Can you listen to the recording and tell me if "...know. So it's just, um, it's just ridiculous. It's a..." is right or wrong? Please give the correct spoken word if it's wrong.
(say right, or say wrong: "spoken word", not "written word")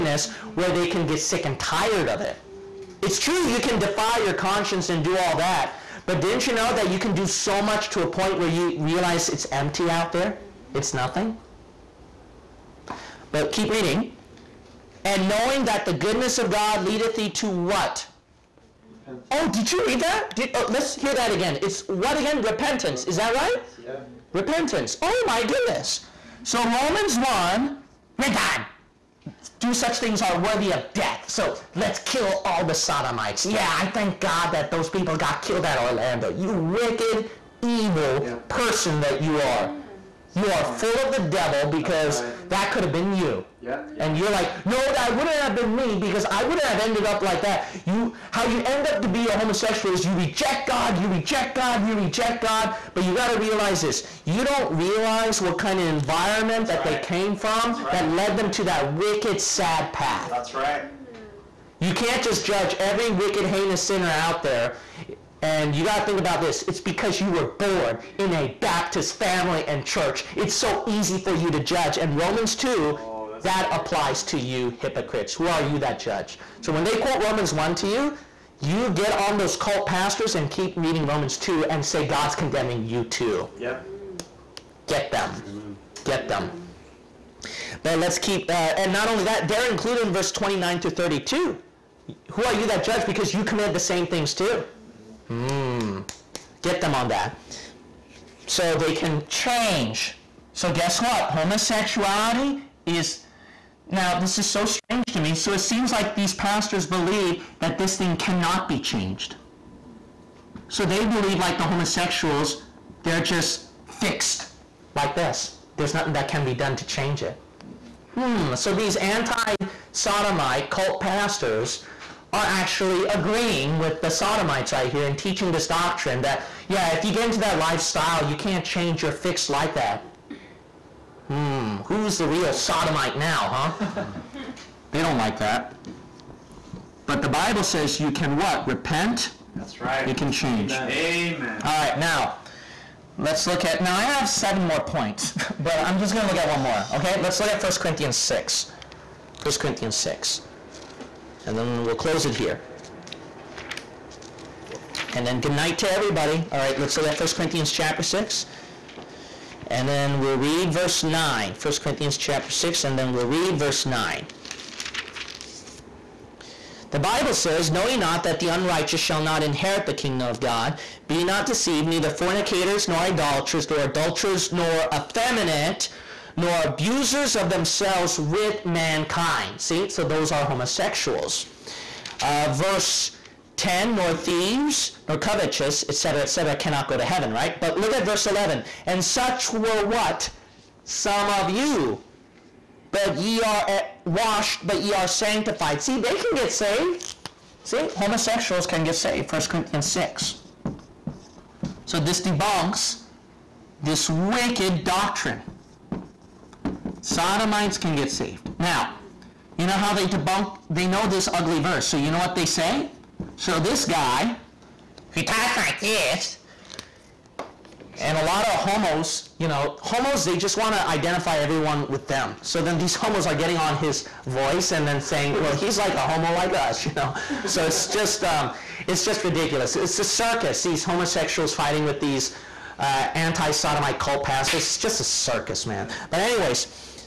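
right.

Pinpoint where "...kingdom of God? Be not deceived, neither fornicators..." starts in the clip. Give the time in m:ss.
2:49.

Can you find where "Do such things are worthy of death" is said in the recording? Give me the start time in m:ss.
0:29.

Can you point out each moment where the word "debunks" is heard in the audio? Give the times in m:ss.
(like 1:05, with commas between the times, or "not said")
3:22, 3:30.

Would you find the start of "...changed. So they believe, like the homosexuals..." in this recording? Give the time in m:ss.
1:48.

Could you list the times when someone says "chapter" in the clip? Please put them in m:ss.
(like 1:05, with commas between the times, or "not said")
2:37, 2:42.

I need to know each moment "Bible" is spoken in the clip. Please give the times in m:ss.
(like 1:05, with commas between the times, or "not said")
2:17, 2:46.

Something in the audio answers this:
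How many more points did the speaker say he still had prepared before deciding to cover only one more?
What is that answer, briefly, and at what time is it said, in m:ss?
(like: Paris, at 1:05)
7, at 2:24.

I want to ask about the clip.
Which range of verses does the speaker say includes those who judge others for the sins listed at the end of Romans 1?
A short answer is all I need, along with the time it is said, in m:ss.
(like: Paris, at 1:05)
29 to 32, at 1:30.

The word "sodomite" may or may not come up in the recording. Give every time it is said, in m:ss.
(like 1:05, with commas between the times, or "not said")
0:32, 1:59, 2:04, 2:12, 3:27, 3:53.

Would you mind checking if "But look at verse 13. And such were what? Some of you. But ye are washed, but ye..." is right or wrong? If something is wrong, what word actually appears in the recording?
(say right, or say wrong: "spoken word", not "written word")
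wrong: "11", not "13".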